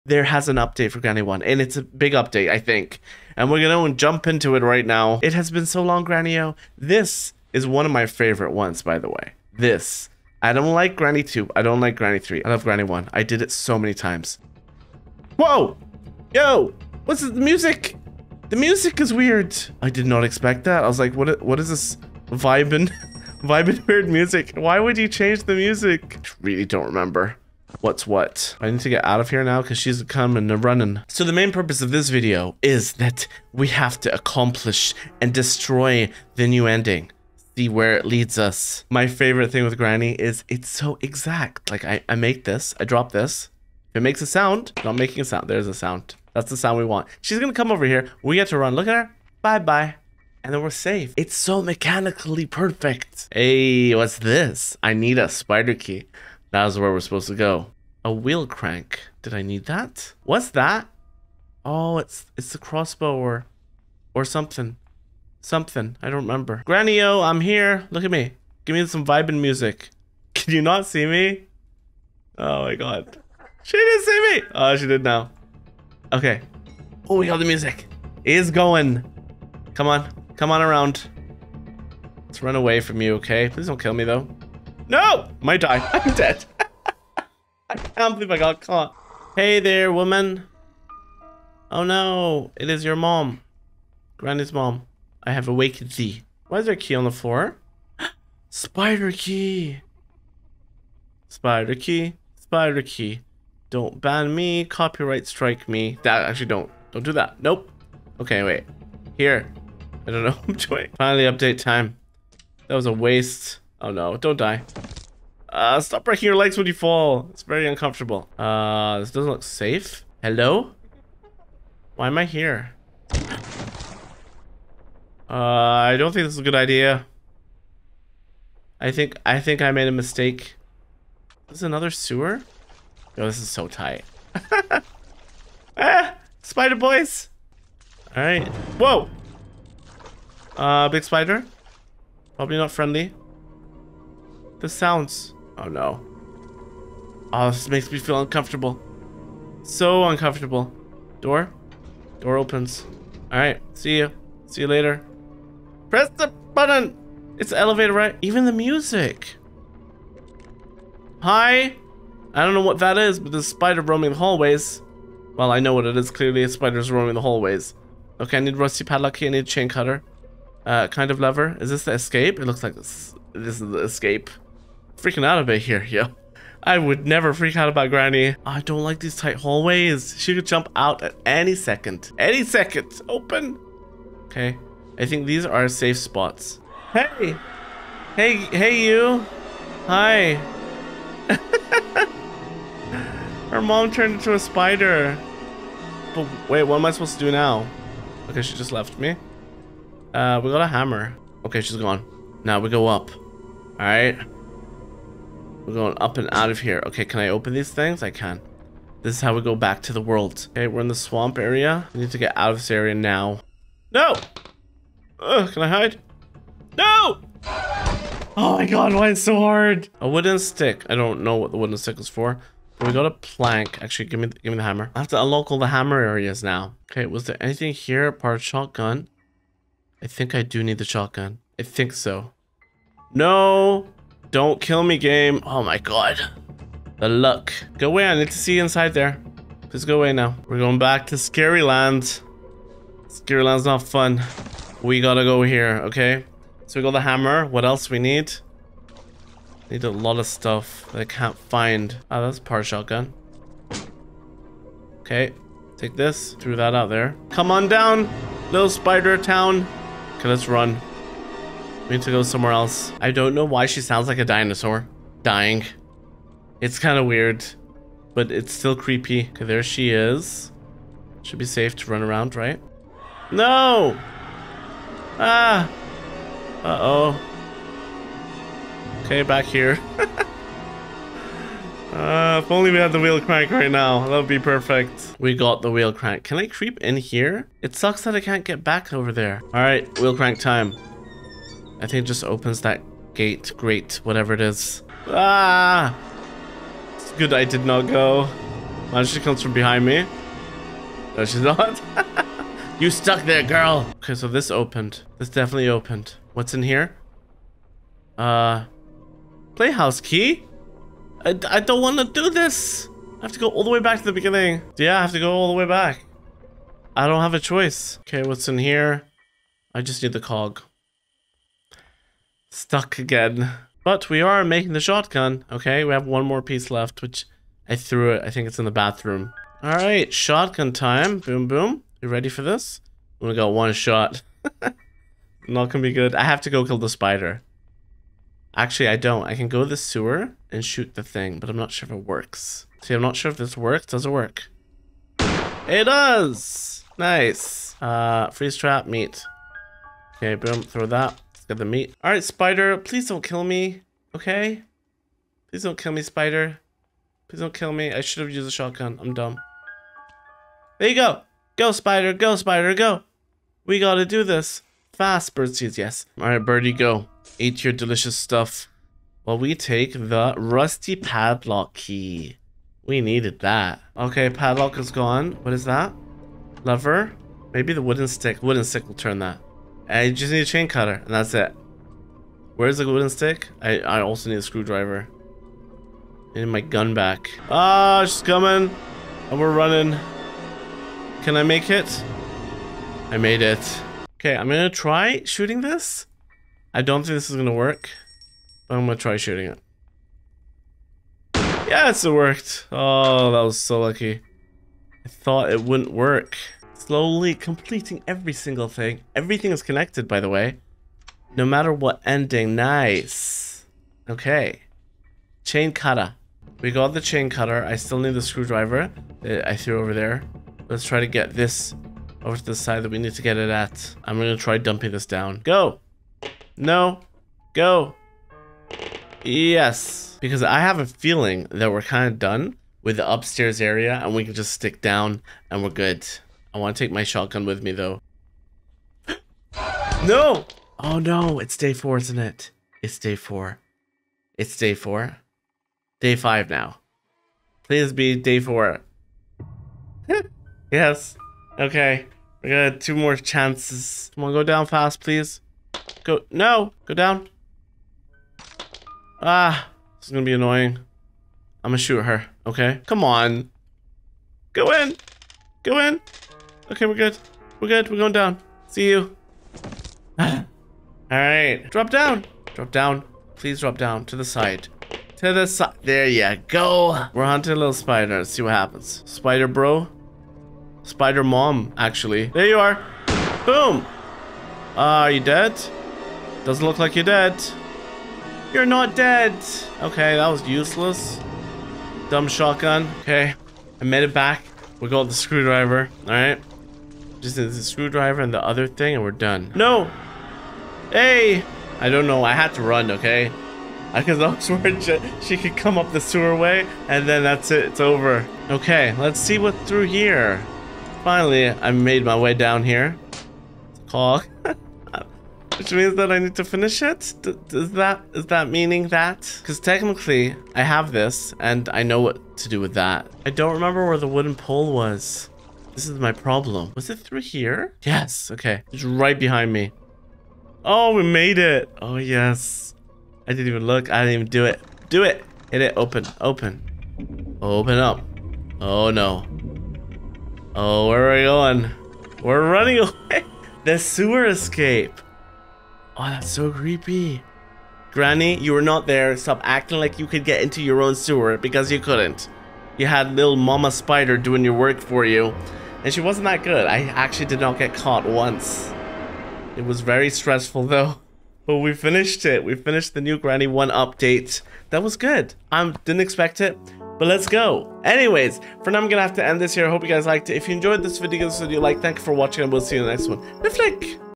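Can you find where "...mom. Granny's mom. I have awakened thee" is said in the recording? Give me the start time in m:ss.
1:32.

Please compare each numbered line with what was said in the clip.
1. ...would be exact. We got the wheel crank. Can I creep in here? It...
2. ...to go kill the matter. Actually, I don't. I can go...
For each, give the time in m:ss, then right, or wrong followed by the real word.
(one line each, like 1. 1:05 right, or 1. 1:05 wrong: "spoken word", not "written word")
1. 4:44 wrong: "perfect", not "exact"
2. 5:36 wrong: "spider", not "matter".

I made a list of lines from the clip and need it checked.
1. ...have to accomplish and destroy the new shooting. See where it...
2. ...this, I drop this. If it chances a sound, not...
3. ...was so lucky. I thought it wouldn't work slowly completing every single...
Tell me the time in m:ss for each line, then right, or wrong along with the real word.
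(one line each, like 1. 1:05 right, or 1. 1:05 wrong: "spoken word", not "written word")
1. 0:33 wrong: "ending", not "shooting"
2. 0:42 wrong: "makes", not "chances"
3. 6:43 right.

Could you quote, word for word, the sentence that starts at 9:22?
We finished the new Granny 1 update.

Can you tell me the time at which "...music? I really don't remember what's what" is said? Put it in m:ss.
0:25.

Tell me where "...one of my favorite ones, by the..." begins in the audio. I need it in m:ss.
0:07.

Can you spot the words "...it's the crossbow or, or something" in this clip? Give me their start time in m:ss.
1:02.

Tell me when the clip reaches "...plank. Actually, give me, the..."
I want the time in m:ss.
3:43.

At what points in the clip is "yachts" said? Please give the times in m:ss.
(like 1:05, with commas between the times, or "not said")
not said.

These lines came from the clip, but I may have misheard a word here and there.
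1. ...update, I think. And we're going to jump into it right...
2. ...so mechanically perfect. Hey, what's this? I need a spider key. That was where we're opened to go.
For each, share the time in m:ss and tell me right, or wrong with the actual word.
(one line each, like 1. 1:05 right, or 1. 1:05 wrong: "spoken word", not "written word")
1. 0:02 right
2. 0:51 wrong: "supposed", not "opened".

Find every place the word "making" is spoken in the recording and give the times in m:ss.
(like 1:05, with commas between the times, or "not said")
0:44, 5:24.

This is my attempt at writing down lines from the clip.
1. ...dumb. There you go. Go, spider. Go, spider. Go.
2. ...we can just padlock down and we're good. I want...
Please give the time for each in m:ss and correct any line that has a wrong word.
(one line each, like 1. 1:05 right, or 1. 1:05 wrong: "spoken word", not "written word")
1. 5:59 right
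2. 7:14 wrong: "stick", not "padlock".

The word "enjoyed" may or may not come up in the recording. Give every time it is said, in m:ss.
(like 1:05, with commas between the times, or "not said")
9:30.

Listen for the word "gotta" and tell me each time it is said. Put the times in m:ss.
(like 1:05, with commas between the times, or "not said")
4:05, 6:03.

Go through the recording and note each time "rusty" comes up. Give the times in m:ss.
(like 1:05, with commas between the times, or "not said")
2:48, 6:10.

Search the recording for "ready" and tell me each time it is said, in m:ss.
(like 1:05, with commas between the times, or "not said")
5:32.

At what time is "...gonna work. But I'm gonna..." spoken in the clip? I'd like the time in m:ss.
6:37.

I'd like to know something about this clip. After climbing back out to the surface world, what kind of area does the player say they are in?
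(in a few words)
Swamp area.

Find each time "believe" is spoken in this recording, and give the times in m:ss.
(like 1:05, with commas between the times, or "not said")
1:28.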